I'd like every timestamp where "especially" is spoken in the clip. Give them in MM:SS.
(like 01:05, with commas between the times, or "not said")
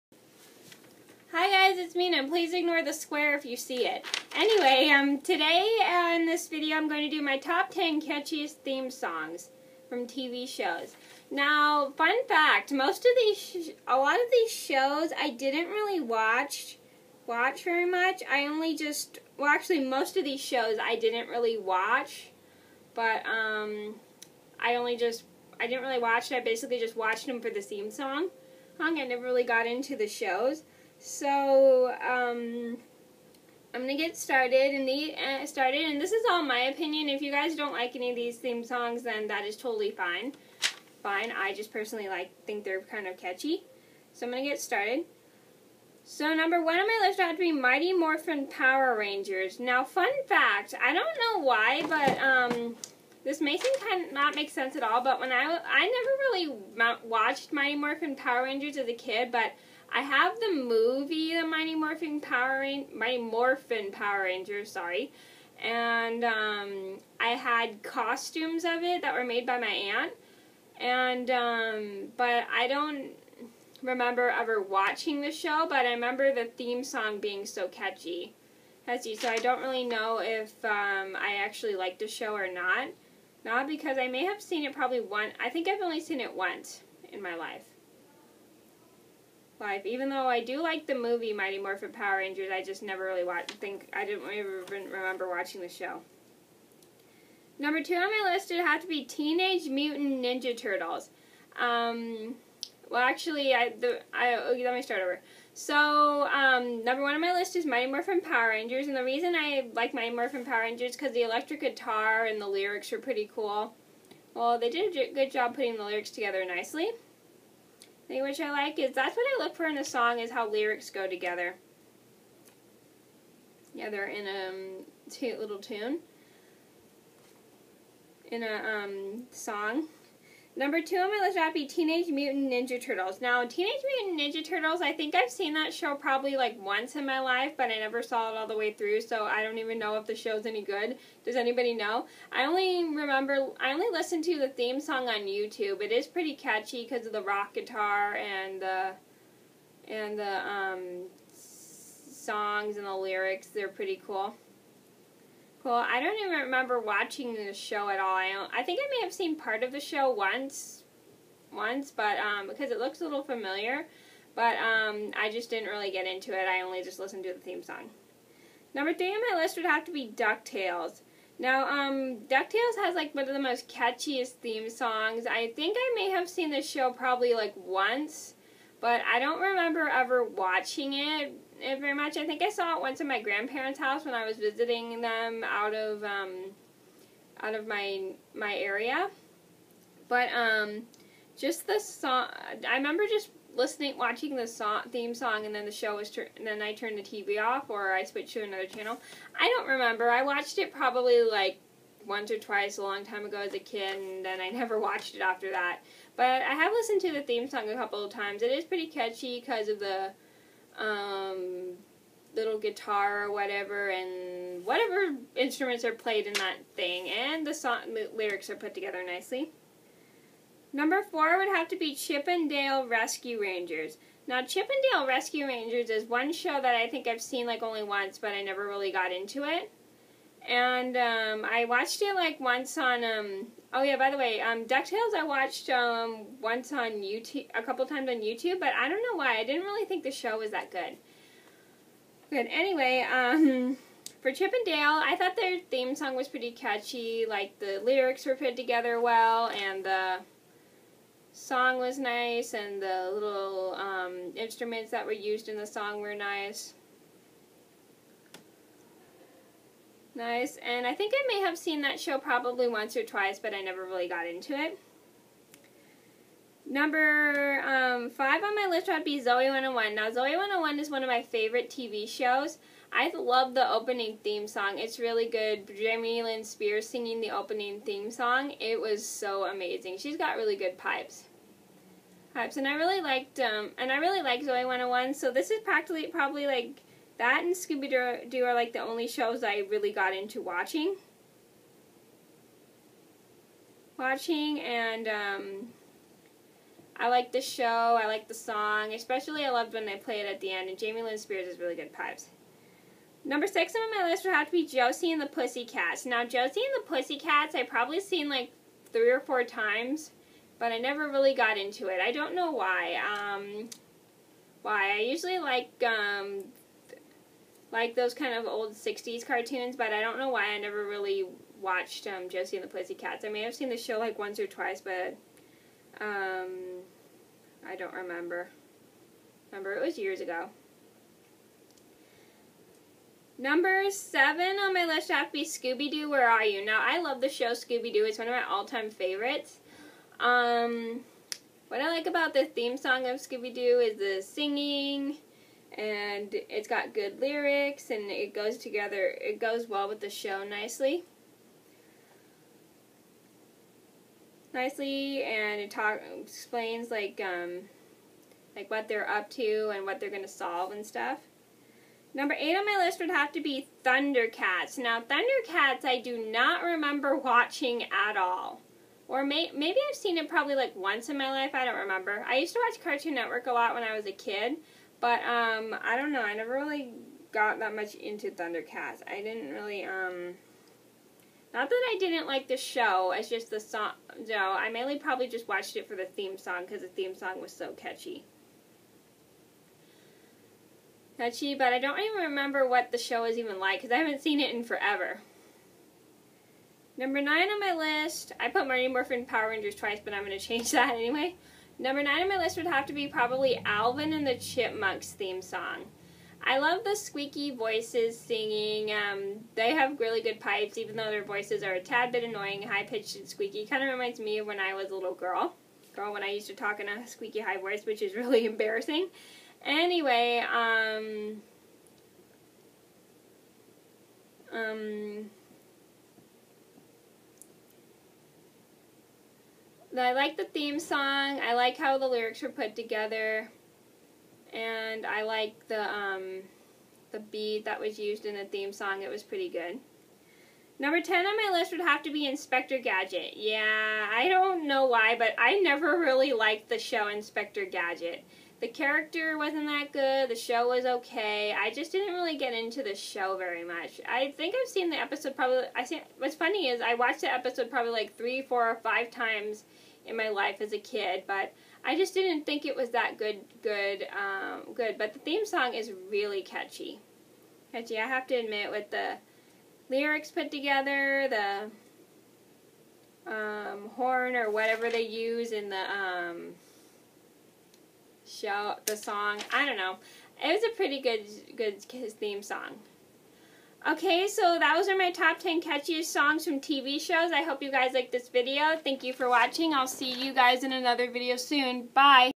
04:58.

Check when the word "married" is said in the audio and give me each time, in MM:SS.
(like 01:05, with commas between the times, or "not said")
not said.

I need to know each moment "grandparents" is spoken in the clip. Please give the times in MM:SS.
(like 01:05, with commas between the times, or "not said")
03:03.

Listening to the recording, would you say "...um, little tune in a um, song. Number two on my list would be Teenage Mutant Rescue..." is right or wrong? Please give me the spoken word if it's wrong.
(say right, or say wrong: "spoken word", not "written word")
wrong: "Ninja", not "Rescue".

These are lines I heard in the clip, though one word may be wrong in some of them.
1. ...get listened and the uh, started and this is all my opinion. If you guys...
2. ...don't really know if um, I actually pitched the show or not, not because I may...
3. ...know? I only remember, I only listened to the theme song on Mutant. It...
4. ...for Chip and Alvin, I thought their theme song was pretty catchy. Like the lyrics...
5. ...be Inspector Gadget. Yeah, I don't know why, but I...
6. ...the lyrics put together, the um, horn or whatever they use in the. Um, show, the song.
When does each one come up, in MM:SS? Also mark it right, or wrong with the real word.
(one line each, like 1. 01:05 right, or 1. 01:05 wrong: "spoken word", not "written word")
1. 00:33 wrong: "started", not "listened"
2. 01:19 wrong: "liked", not "pitched"
3. 02:21 wrong: "YouTube", not "Mutant"
4. 04:04 wrong: "Dale", not "Alvin"
5. 07:22 right
6. 07:48 right.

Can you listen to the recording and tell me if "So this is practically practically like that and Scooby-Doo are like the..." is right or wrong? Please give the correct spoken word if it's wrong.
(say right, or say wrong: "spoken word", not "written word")
wrong: "probably", not "practically".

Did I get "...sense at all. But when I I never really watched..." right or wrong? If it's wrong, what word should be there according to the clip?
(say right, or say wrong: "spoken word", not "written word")
right.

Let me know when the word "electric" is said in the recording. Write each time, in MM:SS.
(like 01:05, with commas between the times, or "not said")
01:51.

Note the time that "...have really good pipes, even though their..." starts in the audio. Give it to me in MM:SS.
06:49.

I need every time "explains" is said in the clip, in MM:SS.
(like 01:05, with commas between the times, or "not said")
05:56.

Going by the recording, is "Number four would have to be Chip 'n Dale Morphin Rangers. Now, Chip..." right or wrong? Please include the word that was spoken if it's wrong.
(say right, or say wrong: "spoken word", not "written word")
wrong: "Rescue", not "Morphin".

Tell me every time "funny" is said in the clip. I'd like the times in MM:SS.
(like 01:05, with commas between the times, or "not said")
07:36.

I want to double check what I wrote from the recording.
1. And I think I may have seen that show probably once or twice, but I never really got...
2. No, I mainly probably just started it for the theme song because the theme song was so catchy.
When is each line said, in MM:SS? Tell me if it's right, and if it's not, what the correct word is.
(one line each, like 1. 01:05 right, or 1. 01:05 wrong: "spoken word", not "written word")
1. 04:20 right
2. 06:24 wrong: "watched", not "started".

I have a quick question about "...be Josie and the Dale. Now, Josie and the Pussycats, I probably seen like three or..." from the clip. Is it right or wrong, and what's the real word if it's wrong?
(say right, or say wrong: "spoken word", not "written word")
wrong: "Pussycats", not "Dale".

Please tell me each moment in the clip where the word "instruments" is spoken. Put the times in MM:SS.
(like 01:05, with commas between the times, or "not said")
03:35, 04:14.